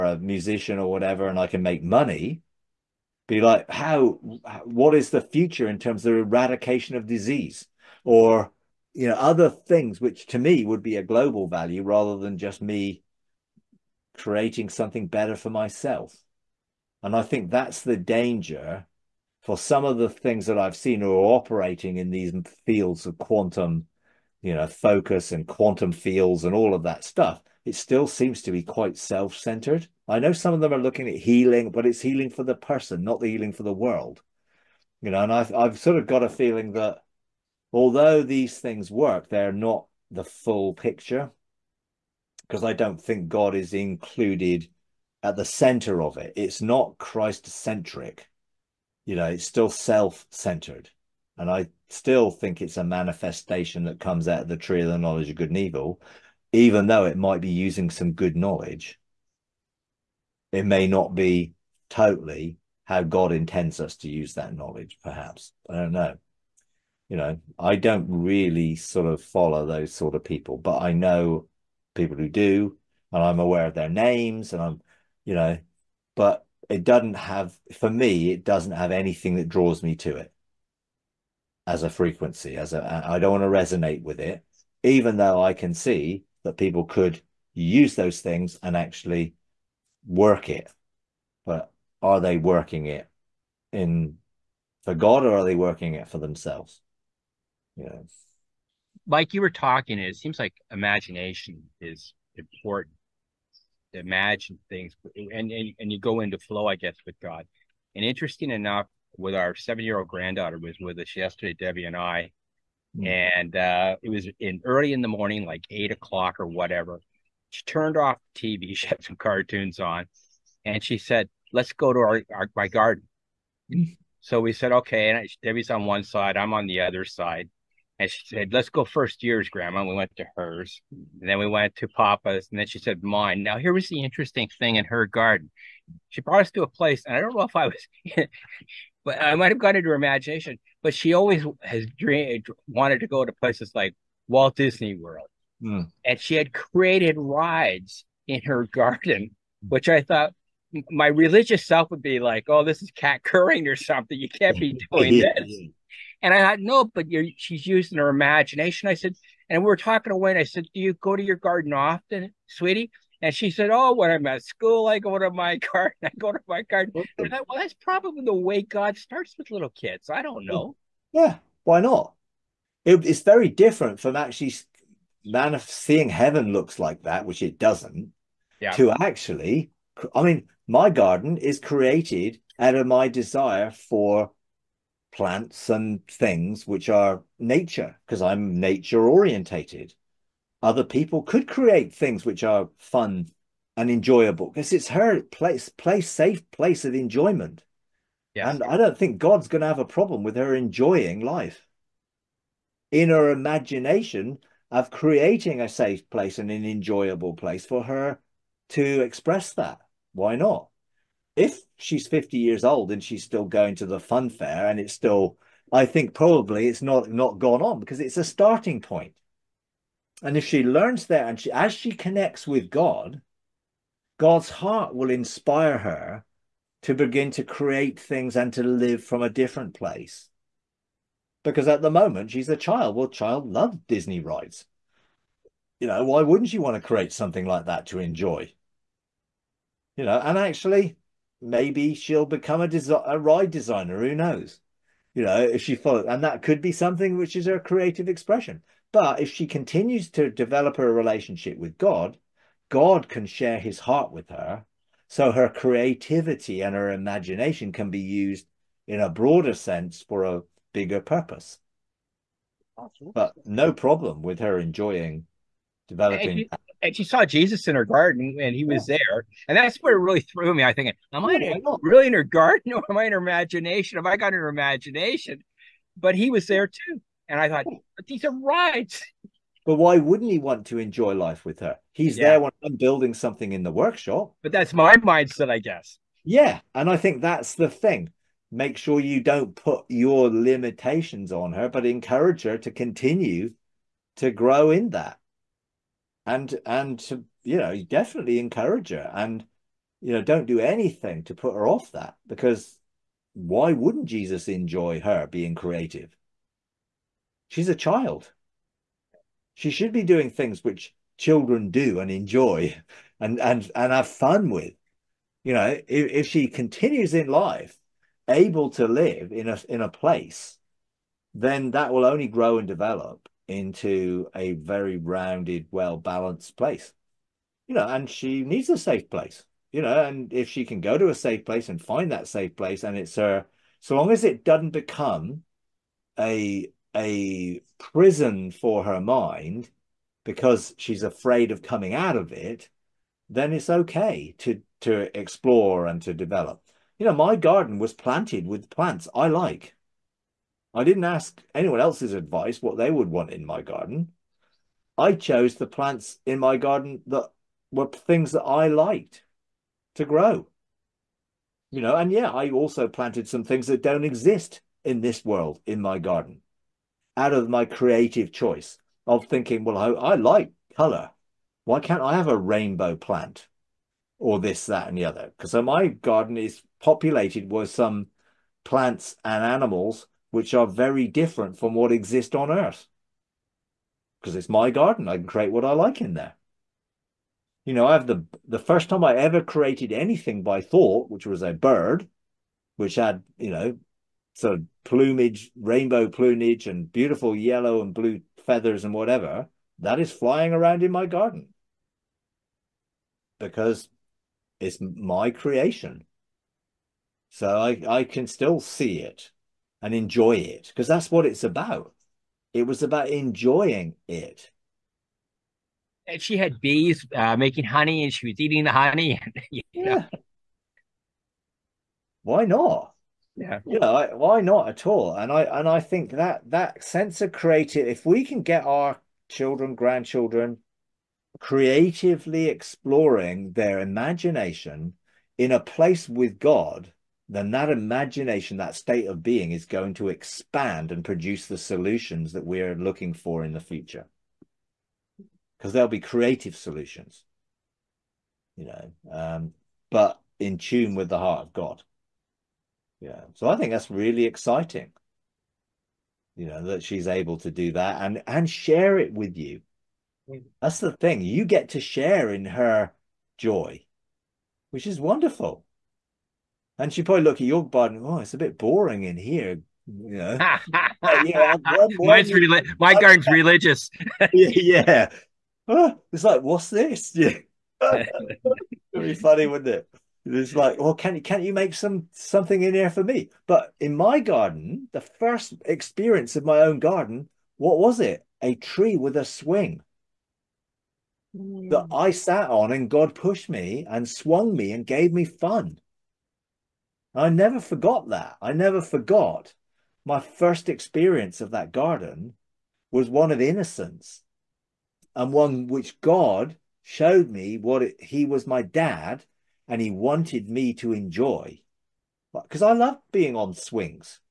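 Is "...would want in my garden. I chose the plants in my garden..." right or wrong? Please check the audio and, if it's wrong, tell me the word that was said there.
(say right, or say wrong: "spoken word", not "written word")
right.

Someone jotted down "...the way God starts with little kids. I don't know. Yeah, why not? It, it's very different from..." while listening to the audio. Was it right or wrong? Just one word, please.
right.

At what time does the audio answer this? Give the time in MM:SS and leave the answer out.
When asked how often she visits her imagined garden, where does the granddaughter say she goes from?
02:44.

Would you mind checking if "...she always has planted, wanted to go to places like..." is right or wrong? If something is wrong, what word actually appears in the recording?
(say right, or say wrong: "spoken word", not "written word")
wrong: "dreamed", not "planted".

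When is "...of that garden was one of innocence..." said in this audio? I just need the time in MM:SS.
08:21.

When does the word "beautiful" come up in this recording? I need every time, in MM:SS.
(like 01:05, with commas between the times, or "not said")
06:36.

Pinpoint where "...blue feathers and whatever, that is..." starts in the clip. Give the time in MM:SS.
06:37.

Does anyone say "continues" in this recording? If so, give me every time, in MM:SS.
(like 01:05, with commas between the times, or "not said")
04:09, 04:52, 05:16.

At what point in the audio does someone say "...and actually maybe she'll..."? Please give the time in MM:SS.
04:00.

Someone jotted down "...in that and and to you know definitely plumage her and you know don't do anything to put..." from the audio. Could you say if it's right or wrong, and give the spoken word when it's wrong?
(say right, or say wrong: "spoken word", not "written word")
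wrong: "encourage", not "plumage".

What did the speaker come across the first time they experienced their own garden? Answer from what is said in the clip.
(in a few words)
a tree with a swing.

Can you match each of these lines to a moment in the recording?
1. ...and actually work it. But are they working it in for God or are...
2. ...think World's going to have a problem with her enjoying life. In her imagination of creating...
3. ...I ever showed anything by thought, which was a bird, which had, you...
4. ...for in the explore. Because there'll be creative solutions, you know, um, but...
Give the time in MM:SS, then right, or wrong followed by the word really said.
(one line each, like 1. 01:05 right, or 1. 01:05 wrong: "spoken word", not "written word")
1. 01:28 right
2. 03:18 wrong: "God", not "World"
3. 06:29 wrong: "created", not "showed"
4. 07:23 wrong: "future", not "explore".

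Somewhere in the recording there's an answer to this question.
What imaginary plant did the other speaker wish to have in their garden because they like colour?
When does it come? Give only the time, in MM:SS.
06:12.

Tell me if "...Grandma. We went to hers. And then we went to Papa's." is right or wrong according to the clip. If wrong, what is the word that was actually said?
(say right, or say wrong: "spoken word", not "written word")
right.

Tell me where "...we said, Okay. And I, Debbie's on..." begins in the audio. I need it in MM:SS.
02:04.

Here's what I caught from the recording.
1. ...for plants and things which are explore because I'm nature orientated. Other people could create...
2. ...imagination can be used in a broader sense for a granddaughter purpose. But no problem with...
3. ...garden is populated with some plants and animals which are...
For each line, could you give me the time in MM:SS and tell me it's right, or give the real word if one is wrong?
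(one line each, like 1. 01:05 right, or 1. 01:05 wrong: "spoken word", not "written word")
1. 03:03 wrong: "nature", not "explore"
2. 04:16 wrong: "bigger", not "granddaughter"
3. 06:15 right.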